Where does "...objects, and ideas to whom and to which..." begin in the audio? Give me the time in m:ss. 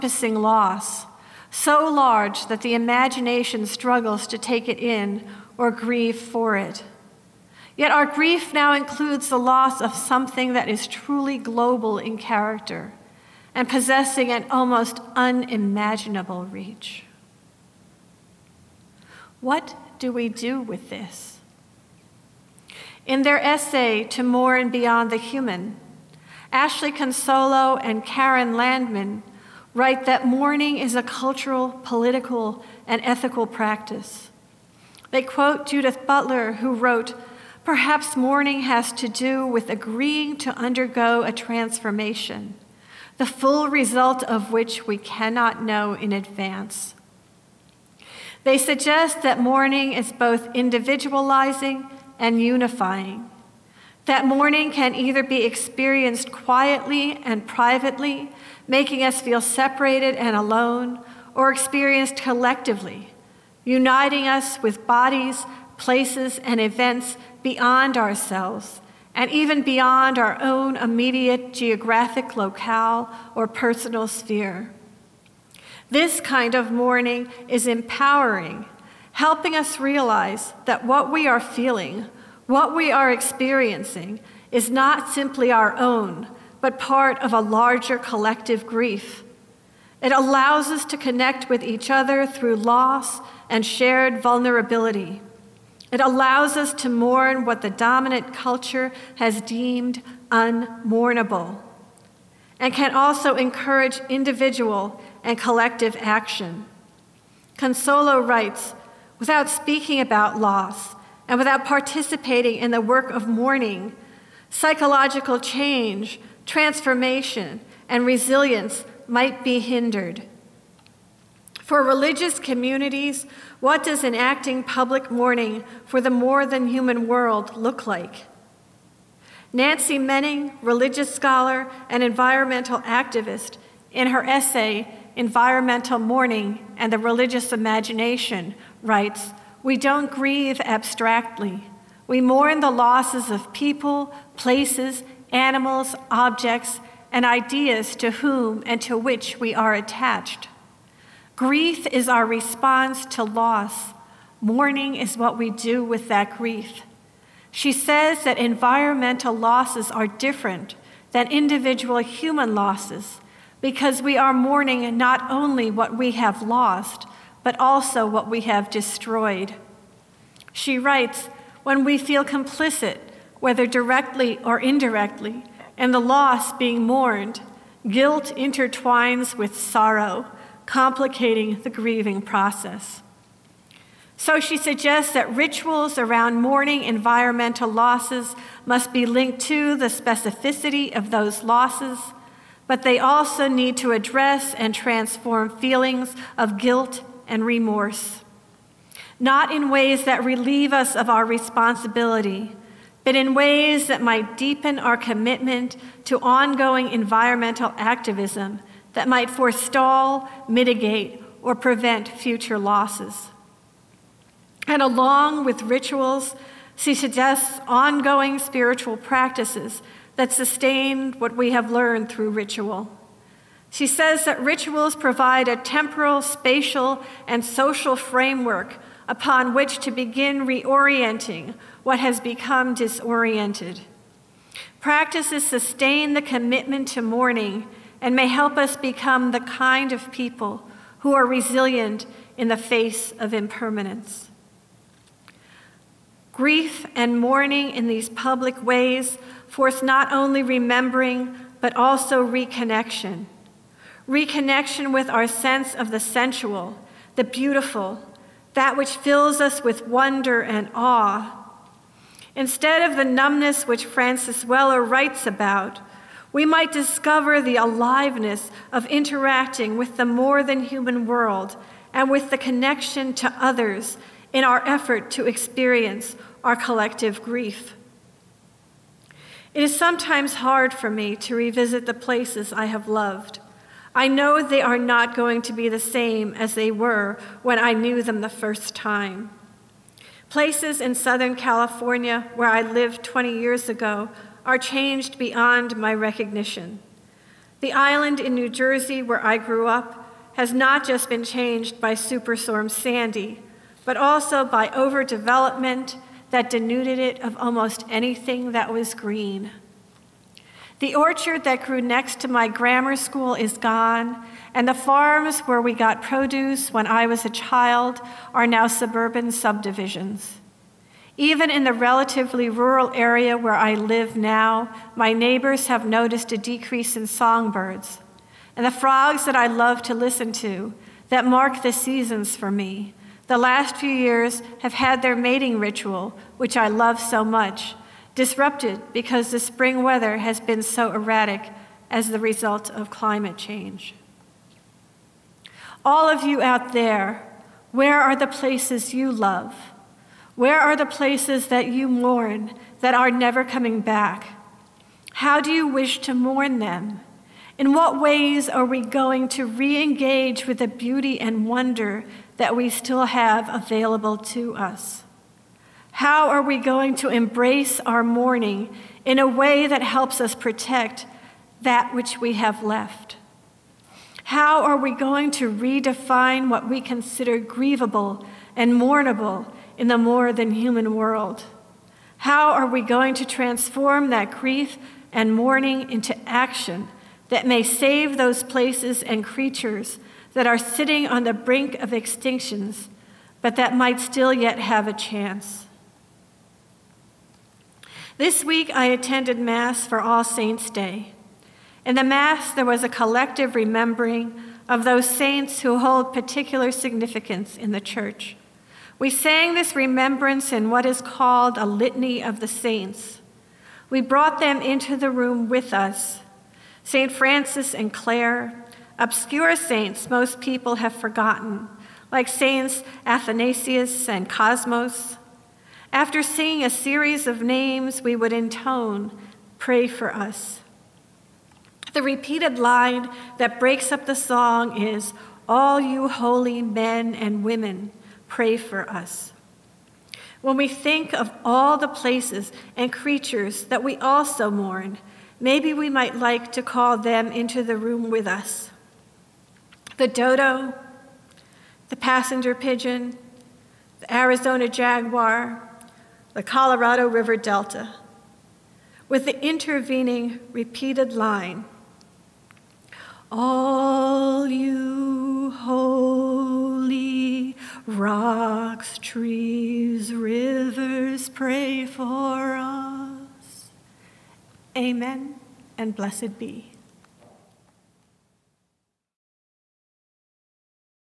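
2:26.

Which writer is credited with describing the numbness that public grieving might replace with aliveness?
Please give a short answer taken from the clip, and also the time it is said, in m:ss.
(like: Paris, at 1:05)
Francis Weller, at 4:23.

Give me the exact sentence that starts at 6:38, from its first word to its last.
This week, I attended Mass for All Saints' Day.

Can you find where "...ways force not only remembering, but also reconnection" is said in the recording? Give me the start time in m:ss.
4:08.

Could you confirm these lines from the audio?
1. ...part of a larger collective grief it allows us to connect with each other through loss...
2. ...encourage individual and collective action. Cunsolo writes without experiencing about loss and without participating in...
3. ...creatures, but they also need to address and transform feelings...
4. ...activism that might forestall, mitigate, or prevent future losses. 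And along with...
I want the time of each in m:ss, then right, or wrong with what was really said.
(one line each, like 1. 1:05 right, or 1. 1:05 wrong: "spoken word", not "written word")
1. 1:26 right
2. 1:43 wrong: "speaking", not "experiencing"
3. 3:11 wrong: "losses", not "creatures"
4. 3:27 right.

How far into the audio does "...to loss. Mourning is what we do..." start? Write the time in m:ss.
2:33.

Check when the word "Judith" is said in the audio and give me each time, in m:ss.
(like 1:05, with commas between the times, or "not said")
0:35.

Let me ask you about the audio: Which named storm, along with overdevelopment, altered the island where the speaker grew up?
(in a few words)
Superstorm Sandy.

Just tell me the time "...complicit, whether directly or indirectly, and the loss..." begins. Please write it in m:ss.
2:52.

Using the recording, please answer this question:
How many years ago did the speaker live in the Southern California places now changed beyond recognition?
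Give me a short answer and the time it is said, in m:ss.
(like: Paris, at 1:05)
20, at 4:53.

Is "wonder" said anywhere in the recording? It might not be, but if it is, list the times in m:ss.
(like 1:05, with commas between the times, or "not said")
4:19, 6:01.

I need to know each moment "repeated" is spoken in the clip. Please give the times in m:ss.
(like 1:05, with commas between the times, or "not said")
7:12, 7:40.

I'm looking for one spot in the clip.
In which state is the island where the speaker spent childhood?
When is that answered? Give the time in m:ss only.
4:58.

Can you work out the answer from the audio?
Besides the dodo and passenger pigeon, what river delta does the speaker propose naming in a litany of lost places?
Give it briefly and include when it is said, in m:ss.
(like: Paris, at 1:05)
Colorado River Delta, at 7:36.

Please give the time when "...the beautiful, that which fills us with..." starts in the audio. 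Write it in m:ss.
4:17.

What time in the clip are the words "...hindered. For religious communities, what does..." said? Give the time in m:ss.
1:59.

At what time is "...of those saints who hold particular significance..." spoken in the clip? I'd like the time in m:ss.
6:44.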